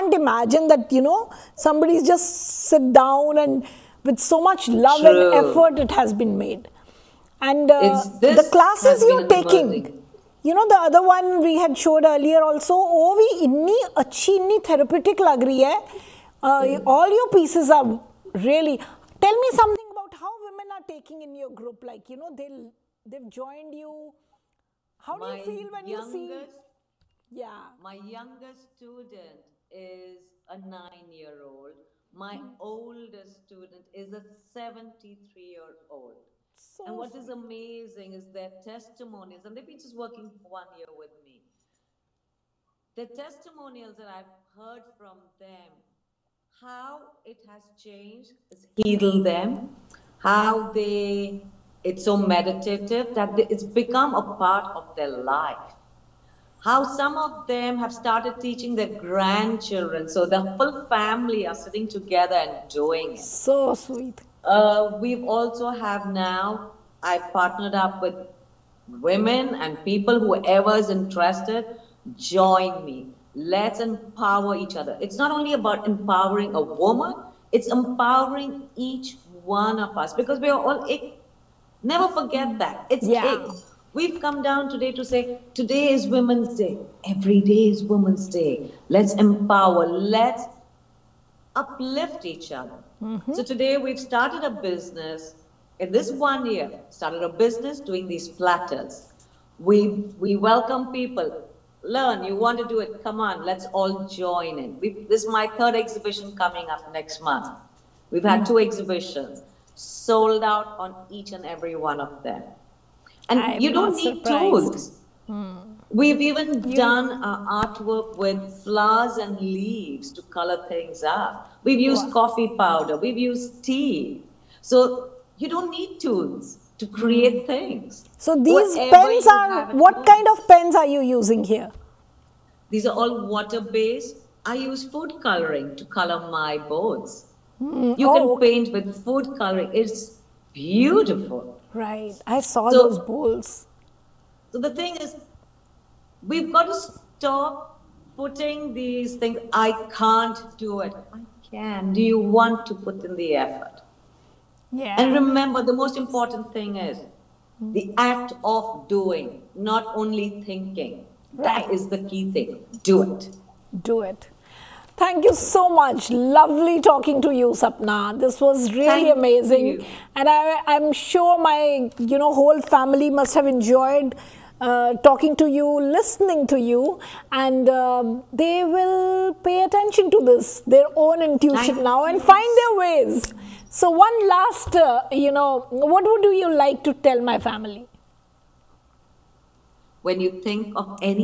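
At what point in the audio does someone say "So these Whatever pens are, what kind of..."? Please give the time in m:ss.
2:08.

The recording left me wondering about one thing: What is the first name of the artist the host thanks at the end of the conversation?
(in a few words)
Sapna.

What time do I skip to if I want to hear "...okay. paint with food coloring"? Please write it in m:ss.
2:18.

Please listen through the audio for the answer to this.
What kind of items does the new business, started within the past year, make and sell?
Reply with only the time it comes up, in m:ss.
1:38.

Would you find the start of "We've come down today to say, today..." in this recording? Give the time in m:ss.
1:23.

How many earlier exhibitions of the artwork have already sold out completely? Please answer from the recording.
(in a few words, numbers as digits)
2.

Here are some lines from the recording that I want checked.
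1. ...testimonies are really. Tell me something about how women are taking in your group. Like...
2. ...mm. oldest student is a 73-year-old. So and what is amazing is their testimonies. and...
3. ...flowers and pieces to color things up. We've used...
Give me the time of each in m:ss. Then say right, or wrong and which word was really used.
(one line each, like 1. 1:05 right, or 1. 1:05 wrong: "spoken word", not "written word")
1. 0:17 wrong: "pieces", not "testimonies"
2. 0:32 right
3. 1:58 wrong: "leaves", not "pieces".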